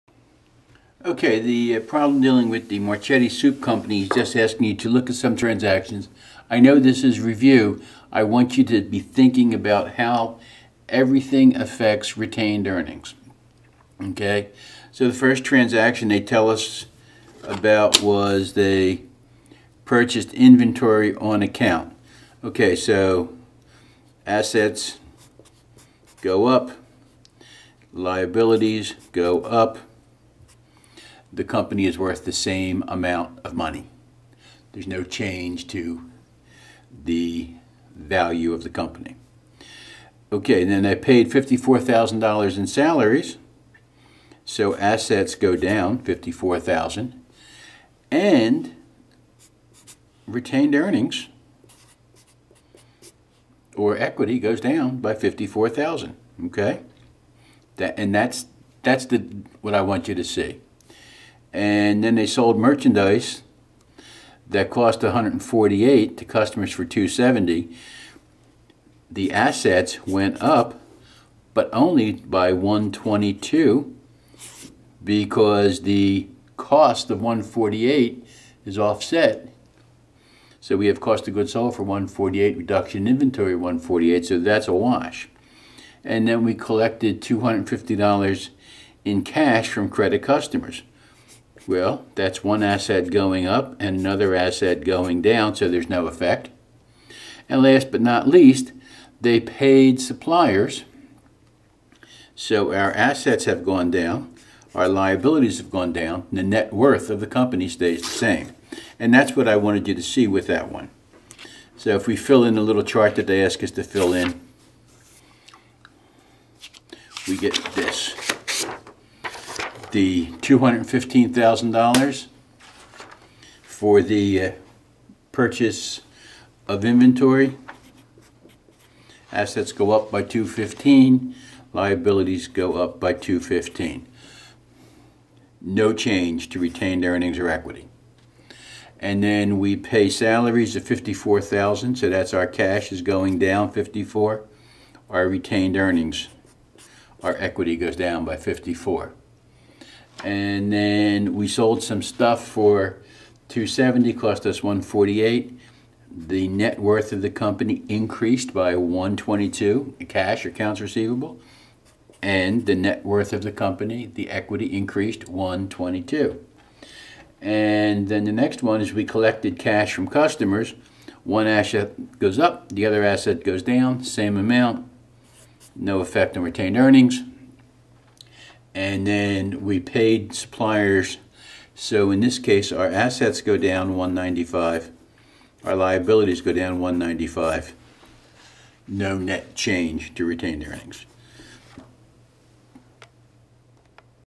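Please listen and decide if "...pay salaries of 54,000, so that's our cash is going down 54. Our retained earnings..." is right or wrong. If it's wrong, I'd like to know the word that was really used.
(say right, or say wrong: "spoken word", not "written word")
right.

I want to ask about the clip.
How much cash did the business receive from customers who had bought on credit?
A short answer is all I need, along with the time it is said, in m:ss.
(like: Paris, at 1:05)
$250, at 1:27.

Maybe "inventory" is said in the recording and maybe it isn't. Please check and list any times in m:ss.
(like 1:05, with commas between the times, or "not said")
0:20, 1:23, 2:06.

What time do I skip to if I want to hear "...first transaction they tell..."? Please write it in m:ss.
0:15.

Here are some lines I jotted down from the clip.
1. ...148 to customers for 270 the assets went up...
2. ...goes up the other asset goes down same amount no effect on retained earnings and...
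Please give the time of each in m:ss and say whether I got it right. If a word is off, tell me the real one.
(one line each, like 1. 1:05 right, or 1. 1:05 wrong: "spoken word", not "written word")
1. 1:05 right
2. 2:52 right.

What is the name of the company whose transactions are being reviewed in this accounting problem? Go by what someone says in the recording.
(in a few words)
Marchetti Soup Company.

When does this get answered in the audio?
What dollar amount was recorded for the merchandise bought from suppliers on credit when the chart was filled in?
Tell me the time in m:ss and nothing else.
2:00.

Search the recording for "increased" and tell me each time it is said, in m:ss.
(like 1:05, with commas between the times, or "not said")
2:37, 2:44.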